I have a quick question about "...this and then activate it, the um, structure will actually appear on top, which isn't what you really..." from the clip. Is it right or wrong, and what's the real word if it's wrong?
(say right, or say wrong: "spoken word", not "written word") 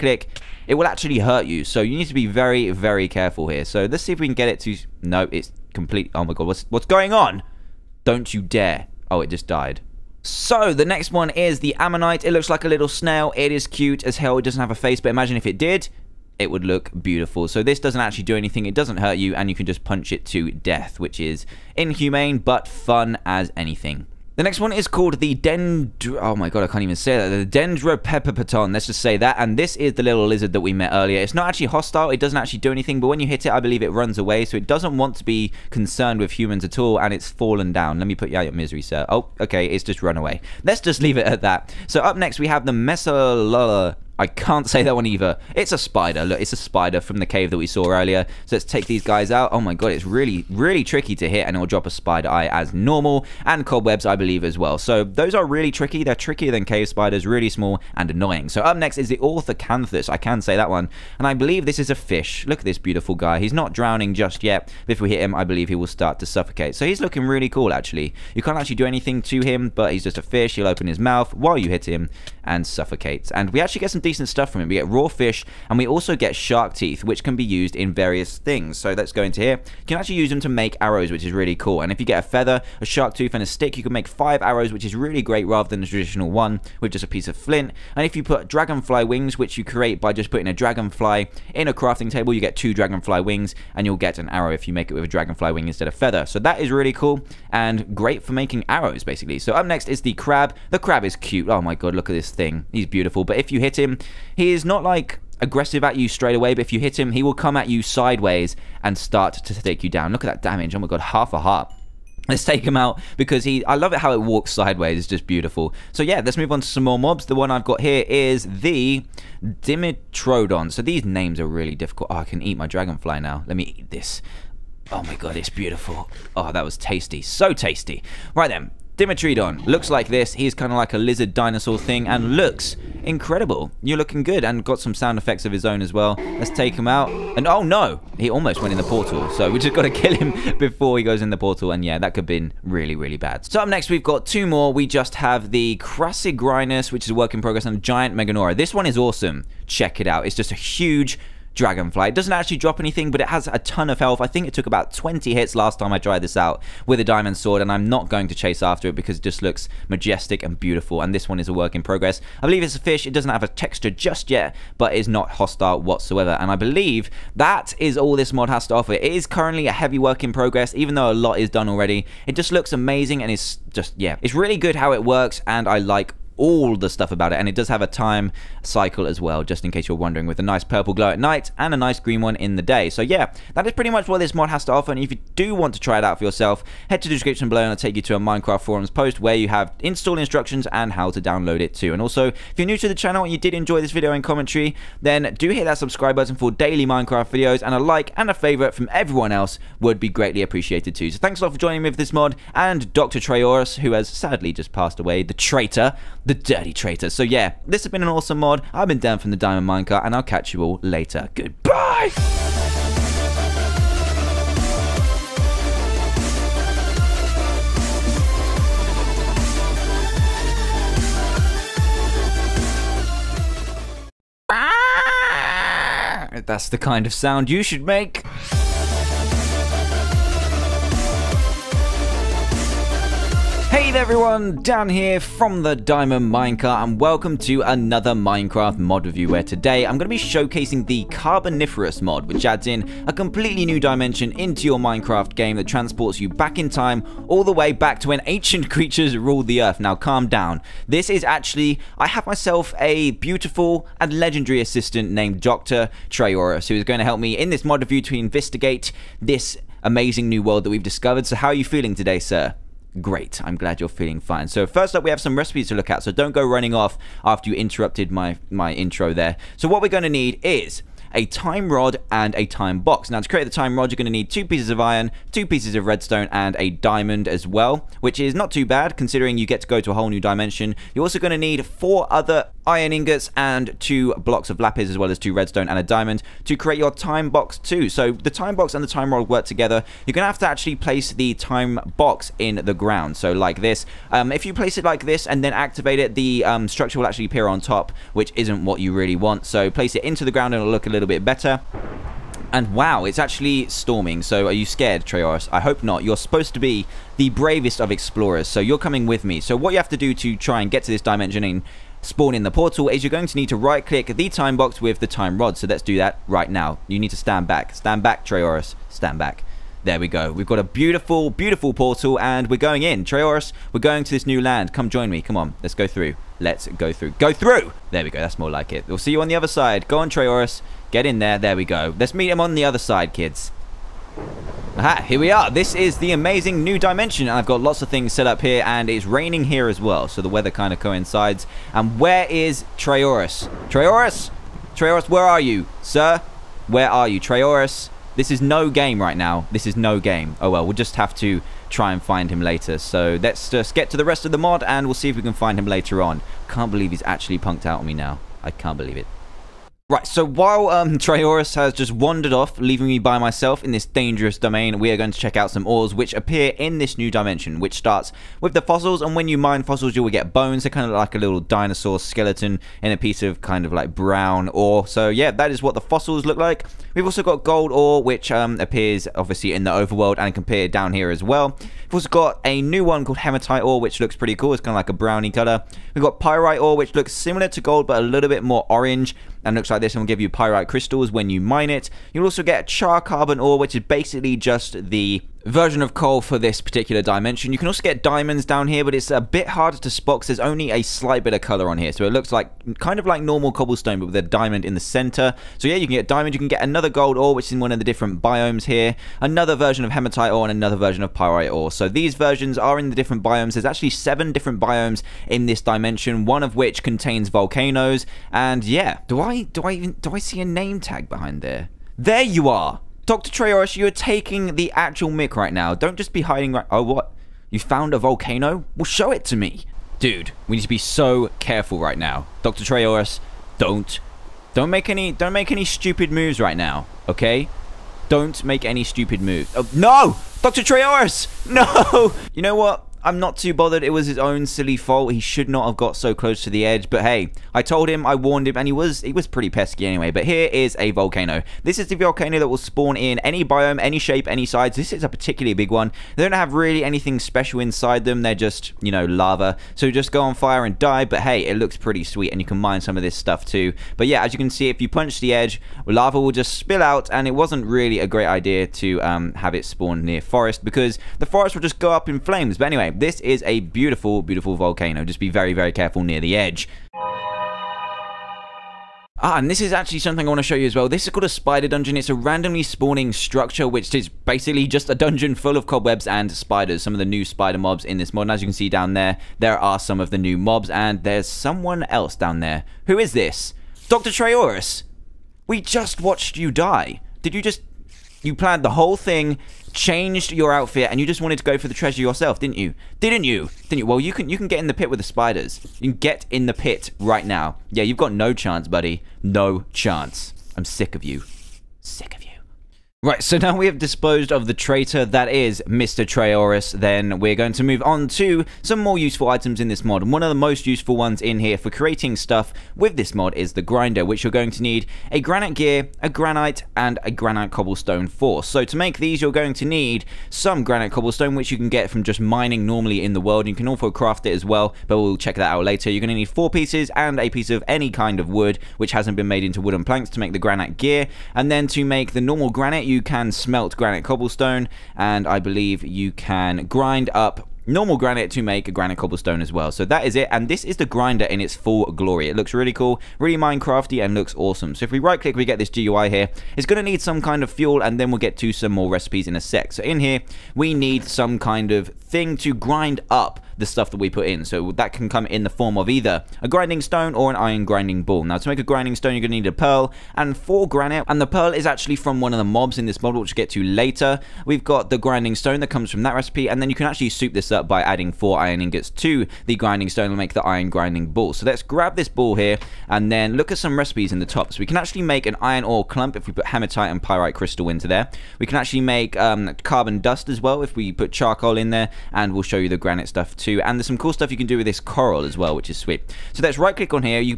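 right.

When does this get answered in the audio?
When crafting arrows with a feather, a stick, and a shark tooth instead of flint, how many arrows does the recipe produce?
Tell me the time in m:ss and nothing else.
1:24.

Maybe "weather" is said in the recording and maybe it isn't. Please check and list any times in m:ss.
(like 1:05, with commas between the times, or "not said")
5:40.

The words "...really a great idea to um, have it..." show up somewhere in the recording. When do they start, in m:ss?
7:47.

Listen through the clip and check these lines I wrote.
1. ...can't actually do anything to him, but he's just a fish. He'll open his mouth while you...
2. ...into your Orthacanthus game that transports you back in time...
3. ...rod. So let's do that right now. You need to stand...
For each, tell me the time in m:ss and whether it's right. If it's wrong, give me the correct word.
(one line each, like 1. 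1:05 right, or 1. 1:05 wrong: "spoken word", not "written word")
1. 1:08 right
2. 4:04 wrong: "Minecraft", not "Orthacanthus"
3. 5:15 right.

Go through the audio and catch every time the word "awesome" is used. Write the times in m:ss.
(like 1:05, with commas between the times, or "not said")
2:28, 3:28, 9:14.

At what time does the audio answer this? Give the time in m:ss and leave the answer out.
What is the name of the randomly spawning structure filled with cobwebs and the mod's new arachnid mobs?
8:01.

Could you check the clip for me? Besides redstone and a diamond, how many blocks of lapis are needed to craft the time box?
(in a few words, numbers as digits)
2.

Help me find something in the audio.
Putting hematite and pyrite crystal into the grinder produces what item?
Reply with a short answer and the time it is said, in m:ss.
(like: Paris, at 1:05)
iron ore clump, at 9:45.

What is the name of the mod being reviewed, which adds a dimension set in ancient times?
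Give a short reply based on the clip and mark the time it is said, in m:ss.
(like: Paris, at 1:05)
Carboniferous mod, at 4:01.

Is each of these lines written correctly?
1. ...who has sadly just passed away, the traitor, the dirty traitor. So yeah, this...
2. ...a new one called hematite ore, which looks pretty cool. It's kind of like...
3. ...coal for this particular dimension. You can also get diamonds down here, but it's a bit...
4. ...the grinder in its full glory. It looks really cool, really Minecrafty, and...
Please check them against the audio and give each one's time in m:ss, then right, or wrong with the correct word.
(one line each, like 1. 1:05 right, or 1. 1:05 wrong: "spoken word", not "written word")
1. 3:23 right
2. 6:22 right
3. 6:35 right
4. 9:10 right.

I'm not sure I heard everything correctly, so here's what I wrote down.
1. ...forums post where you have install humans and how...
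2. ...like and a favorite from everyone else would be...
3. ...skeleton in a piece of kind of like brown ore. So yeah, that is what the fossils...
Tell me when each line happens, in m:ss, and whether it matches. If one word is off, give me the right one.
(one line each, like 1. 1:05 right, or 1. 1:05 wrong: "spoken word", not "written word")
1. 3:08 wrong: "instructions", not "humans"
2. 3:17 right
3. 6:11 right.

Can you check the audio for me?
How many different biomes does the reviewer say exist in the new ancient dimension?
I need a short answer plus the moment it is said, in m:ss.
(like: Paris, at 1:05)
7, at 6:53.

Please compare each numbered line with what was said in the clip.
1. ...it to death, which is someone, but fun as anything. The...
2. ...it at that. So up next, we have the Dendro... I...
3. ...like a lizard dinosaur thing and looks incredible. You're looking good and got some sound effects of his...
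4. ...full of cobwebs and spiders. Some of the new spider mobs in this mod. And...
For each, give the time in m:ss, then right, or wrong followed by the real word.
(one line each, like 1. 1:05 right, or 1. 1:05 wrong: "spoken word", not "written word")
1. 0:20 wrong: "inhumane", not "someone"
2. 0:41 wrong: "Mesolala", not "Dendro"
3. 2:10 right
4. 8:05 right.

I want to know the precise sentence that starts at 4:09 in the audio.
Now calm down, this is actually, I have myself a beautiful and legendary assistant named Dr.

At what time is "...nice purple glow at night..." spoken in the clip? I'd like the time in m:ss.
3:00.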